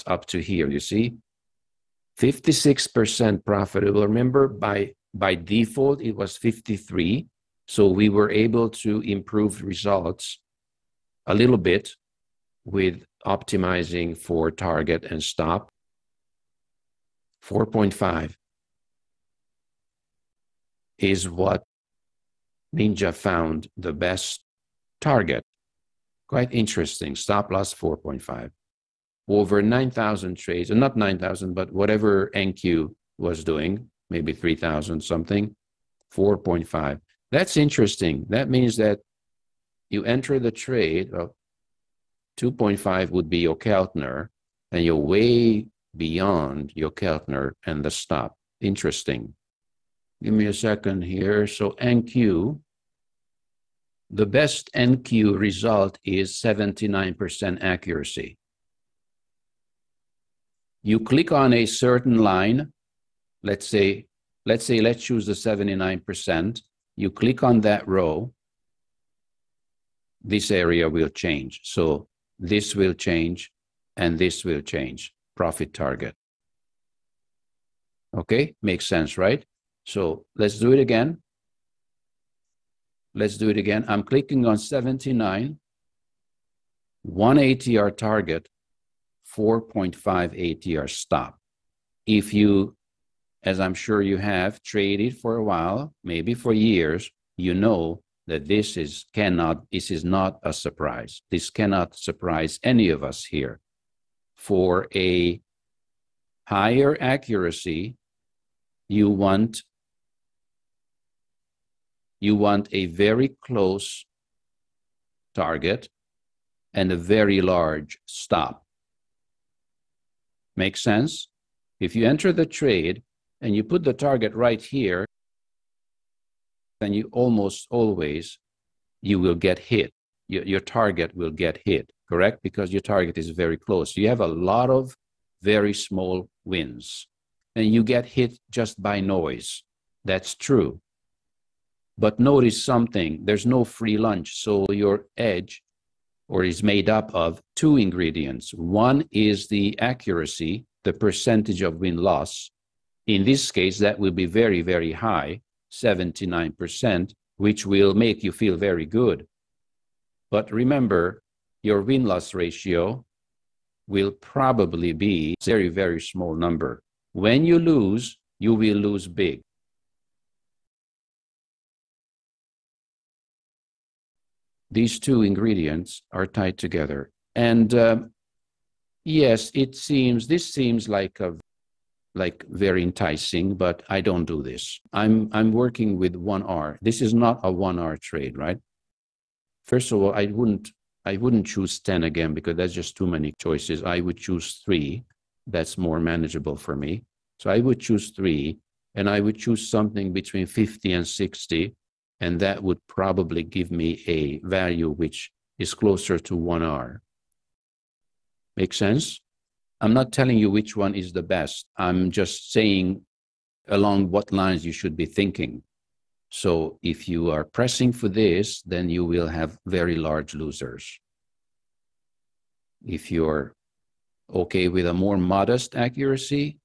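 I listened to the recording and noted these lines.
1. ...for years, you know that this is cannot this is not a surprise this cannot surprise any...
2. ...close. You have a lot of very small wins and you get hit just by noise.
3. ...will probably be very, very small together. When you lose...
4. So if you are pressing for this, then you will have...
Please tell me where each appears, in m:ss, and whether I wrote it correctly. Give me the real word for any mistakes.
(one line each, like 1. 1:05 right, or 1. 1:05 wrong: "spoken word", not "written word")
1. 1:36 right
2. 2:13 right
3. 2:43 wrong: "number", not "together"
4. 3:36 right.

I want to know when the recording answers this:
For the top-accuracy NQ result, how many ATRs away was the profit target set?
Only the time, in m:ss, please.
1:27.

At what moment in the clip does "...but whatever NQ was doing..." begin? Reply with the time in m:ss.
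0:31.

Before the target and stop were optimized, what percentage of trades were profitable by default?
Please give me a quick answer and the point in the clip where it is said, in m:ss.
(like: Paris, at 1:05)
53%, at 0:06.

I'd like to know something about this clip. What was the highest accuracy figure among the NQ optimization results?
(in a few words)
79%.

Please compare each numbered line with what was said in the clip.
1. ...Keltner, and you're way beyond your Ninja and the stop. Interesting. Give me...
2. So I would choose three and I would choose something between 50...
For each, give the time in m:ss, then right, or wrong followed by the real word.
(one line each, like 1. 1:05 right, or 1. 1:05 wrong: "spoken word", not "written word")
1. 0:43 wrong: "Jokernner", not "Ninja"
2. 3:17 right.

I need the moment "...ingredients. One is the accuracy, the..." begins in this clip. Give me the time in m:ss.
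2:27.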